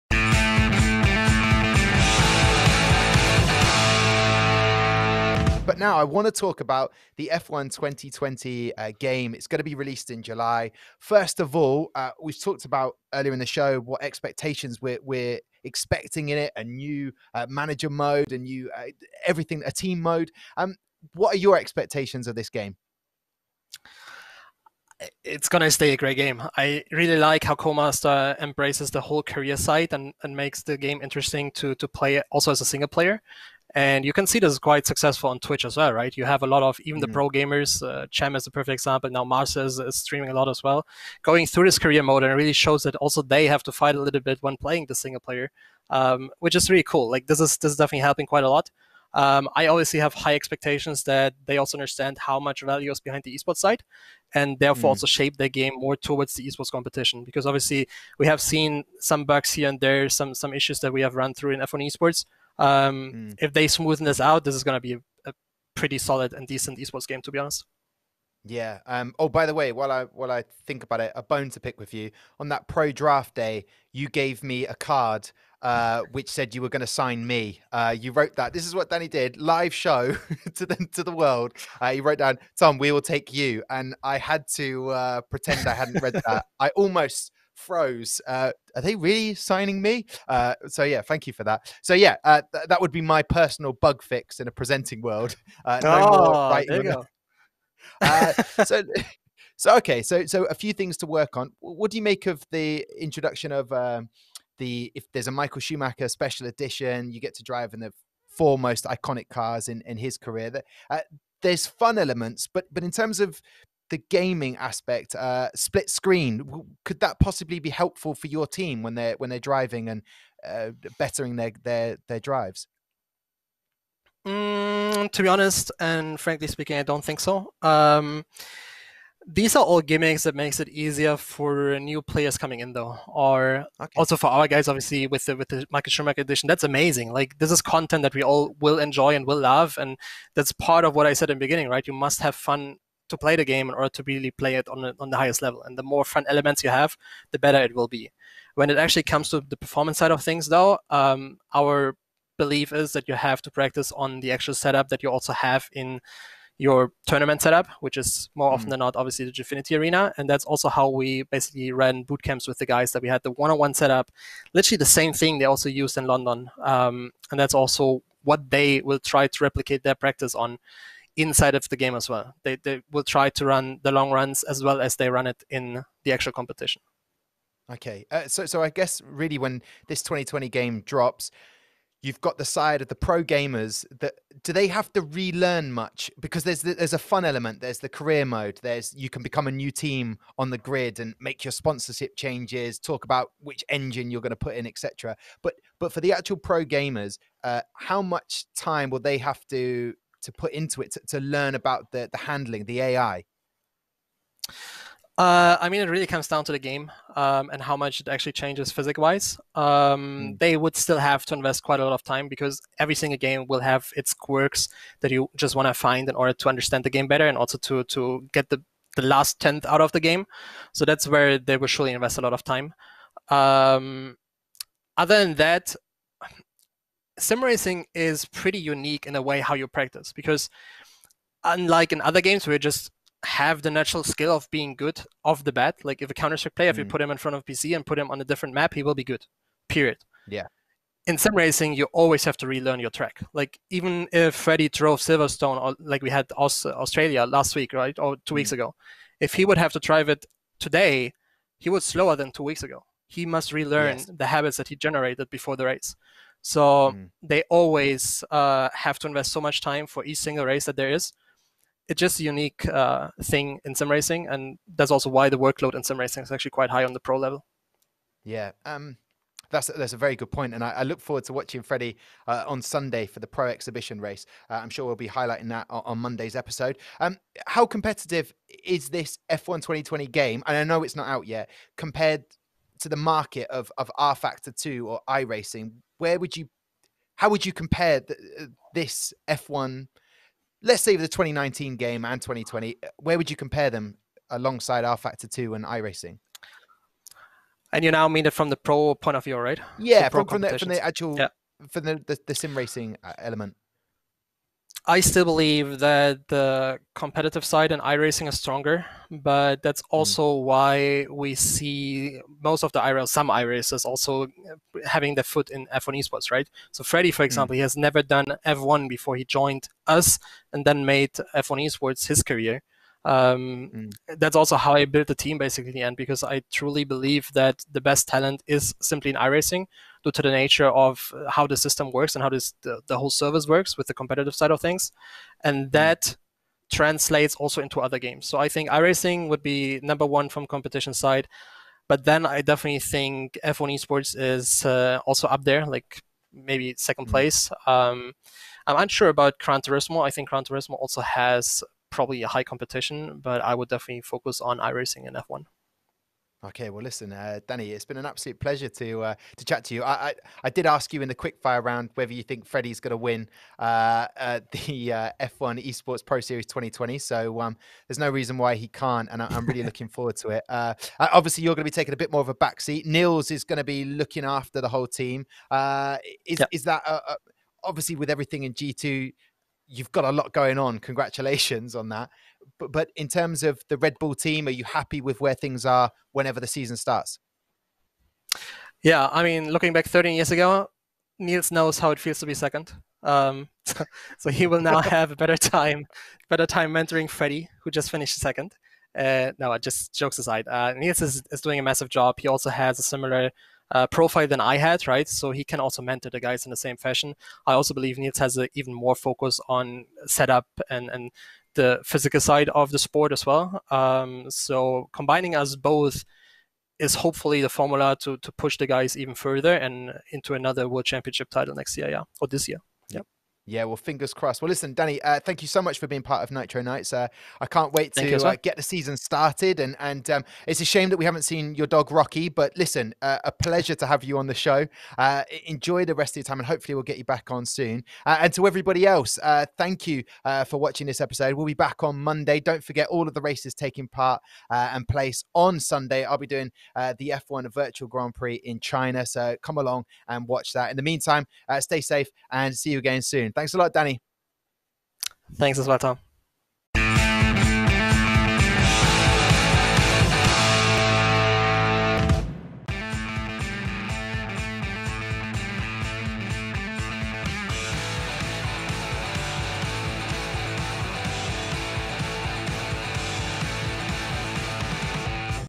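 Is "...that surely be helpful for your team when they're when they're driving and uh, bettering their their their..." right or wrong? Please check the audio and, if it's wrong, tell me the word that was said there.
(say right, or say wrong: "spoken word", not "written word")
wrong: "possibly", not "surely".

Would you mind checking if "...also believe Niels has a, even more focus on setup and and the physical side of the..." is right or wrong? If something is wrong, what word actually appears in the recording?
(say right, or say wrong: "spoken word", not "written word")
right.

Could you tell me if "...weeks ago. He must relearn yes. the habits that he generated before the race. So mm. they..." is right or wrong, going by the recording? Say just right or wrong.
right.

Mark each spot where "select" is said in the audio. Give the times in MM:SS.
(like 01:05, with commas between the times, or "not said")
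not said.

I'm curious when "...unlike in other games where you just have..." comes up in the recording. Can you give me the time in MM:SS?
03:51.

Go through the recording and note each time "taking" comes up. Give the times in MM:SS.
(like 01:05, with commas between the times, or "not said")
06:11, 07:23.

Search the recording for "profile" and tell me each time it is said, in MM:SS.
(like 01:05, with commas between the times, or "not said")
06:43.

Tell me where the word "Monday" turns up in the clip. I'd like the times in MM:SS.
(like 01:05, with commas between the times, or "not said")
04:35, 07:22.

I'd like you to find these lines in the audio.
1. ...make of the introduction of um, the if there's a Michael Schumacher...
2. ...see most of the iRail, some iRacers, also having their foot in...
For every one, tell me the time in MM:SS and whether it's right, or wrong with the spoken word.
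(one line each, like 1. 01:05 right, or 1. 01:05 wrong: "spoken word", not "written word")
1. 01:42 right
2. 05:11 right.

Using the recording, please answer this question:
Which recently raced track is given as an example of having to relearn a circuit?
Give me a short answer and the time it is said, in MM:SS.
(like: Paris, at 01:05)
Australia, at 04:06.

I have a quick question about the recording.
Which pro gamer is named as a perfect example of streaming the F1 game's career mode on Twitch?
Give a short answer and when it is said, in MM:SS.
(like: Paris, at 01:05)
Cem, at 00:38.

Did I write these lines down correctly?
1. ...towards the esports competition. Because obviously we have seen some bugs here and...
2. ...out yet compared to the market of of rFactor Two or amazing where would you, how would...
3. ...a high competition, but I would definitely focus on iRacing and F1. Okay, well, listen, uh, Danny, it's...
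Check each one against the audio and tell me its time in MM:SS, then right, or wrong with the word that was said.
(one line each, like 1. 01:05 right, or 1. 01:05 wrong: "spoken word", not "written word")
1. 00:55 right
2. 04:41 wrong: "iRacing", not "amazing"
3. 05:52 right.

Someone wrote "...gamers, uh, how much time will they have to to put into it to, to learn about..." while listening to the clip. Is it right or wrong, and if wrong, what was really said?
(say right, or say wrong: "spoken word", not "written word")
right.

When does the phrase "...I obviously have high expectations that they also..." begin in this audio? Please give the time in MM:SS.
00:49.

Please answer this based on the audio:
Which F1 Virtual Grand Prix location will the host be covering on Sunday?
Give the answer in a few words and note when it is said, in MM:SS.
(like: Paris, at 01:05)
China, at 07:28.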